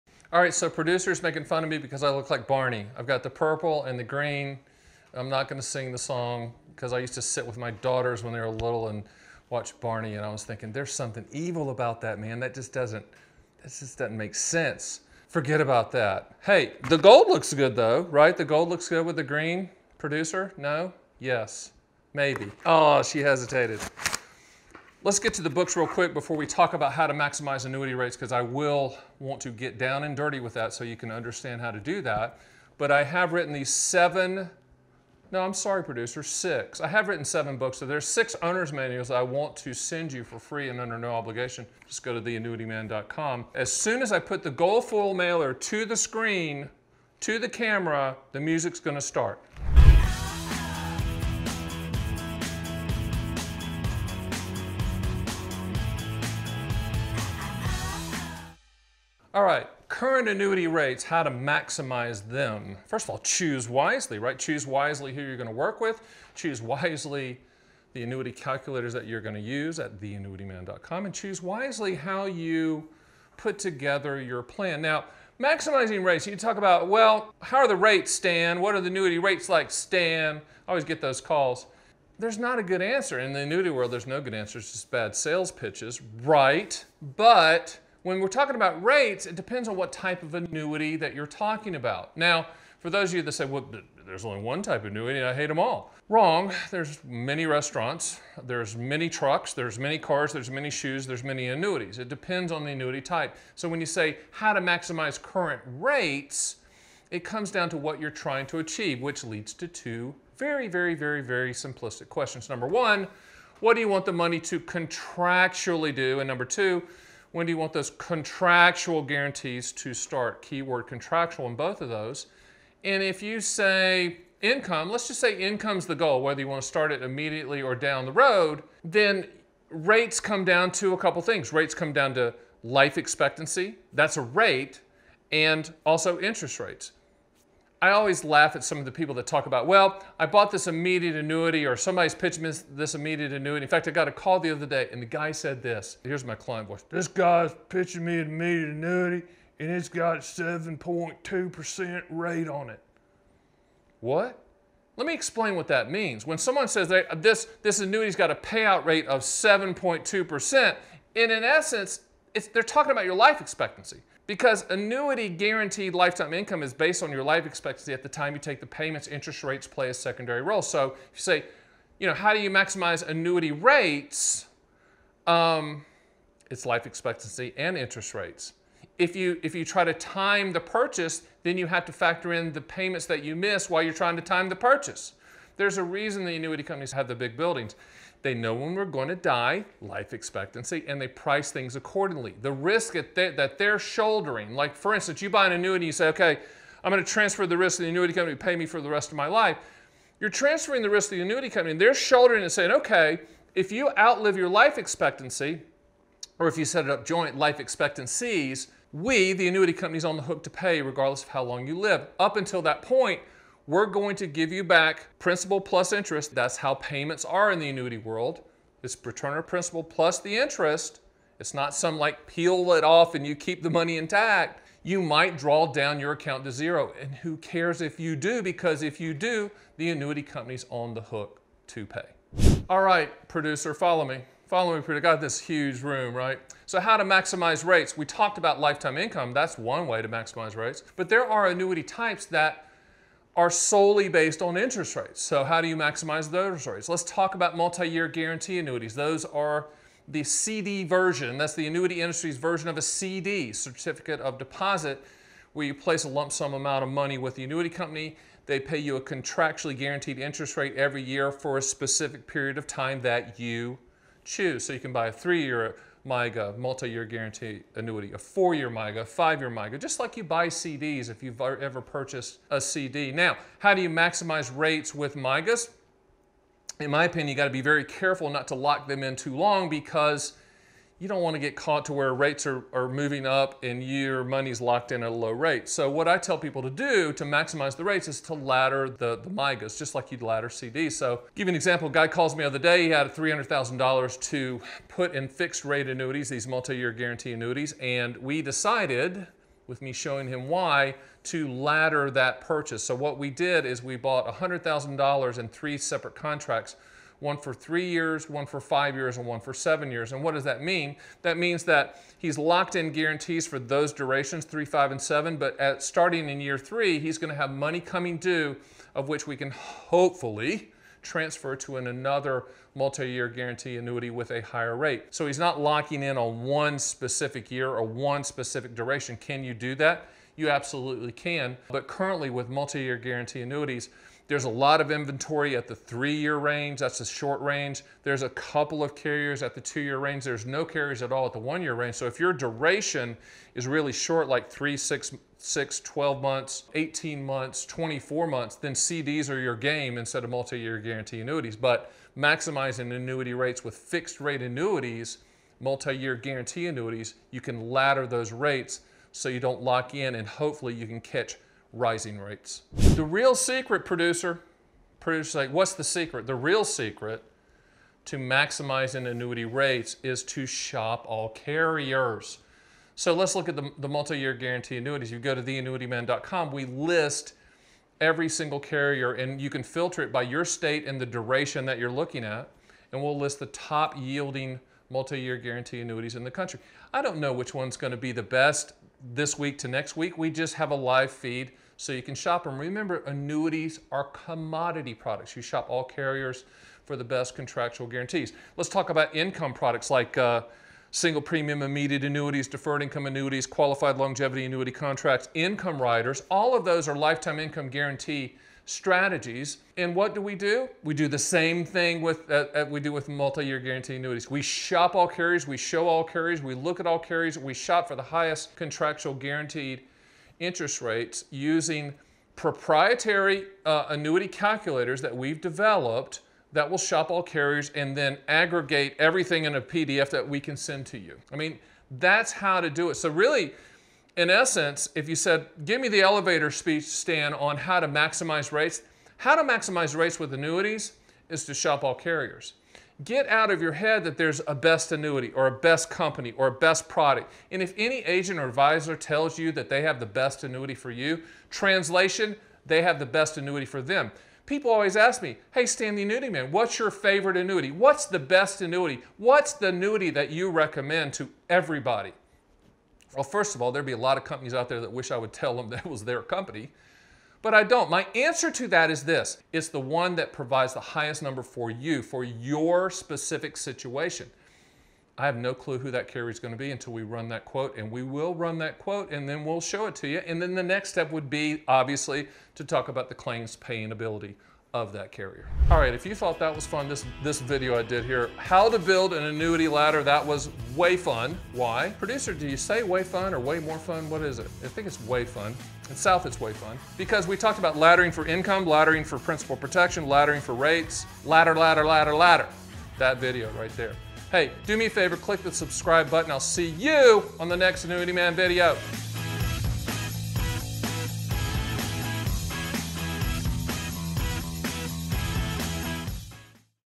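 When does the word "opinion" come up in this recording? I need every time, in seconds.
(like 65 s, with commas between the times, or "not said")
277 s.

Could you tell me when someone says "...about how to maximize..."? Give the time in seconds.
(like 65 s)
26 s.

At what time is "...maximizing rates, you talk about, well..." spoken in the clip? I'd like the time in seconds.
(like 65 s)
75 s.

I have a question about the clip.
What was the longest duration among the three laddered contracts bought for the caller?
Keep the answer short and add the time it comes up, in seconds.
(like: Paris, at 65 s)
7 years, at 309 s.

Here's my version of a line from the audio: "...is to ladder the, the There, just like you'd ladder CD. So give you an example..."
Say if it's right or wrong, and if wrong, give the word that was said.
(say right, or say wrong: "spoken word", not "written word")
wrong: "MYGAs", not "There".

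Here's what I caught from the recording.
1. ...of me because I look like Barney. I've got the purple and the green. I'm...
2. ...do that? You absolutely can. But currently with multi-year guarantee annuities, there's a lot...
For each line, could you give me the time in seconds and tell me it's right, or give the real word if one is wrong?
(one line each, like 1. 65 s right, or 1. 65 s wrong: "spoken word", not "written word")
1. 1 s right
2. 329 s right.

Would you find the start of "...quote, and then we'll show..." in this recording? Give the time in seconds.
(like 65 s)
478 s.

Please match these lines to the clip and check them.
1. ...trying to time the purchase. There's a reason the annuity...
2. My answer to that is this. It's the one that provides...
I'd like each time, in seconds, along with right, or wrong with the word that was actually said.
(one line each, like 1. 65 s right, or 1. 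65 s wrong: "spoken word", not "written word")
1. 183 s right
2. 467 s right.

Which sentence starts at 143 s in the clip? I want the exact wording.
In fact, I got a call the other day and the guy said this.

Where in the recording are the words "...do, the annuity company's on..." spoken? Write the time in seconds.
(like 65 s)
229 s.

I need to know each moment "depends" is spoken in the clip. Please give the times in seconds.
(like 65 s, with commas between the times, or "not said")
89 s, 102 s.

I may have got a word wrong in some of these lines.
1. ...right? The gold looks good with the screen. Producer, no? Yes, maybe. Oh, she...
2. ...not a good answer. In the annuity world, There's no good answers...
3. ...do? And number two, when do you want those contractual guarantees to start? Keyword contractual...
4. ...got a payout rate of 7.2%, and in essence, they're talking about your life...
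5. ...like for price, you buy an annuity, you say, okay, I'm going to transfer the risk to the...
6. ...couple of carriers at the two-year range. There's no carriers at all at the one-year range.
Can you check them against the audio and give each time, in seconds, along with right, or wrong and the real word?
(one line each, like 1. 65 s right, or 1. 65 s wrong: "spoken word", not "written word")
1. 18 s wrong: "green", not "screen"
2. 82 s right
3. 115 s right
4. 158 s right
5. 194 s wrong: "instance", not "price"
6. 338 s right.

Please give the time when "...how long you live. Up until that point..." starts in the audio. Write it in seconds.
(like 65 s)
211 s.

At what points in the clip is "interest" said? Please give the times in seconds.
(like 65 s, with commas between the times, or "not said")
136 s, 169 s, 177 s, 215 s, 220 s, 244 s, 260 s, 420 s.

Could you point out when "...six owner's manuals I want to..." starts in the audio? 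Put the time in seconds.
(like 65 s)
38 s.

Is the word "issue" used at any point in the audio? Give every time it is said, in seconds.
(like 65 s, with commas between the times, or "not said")
not said.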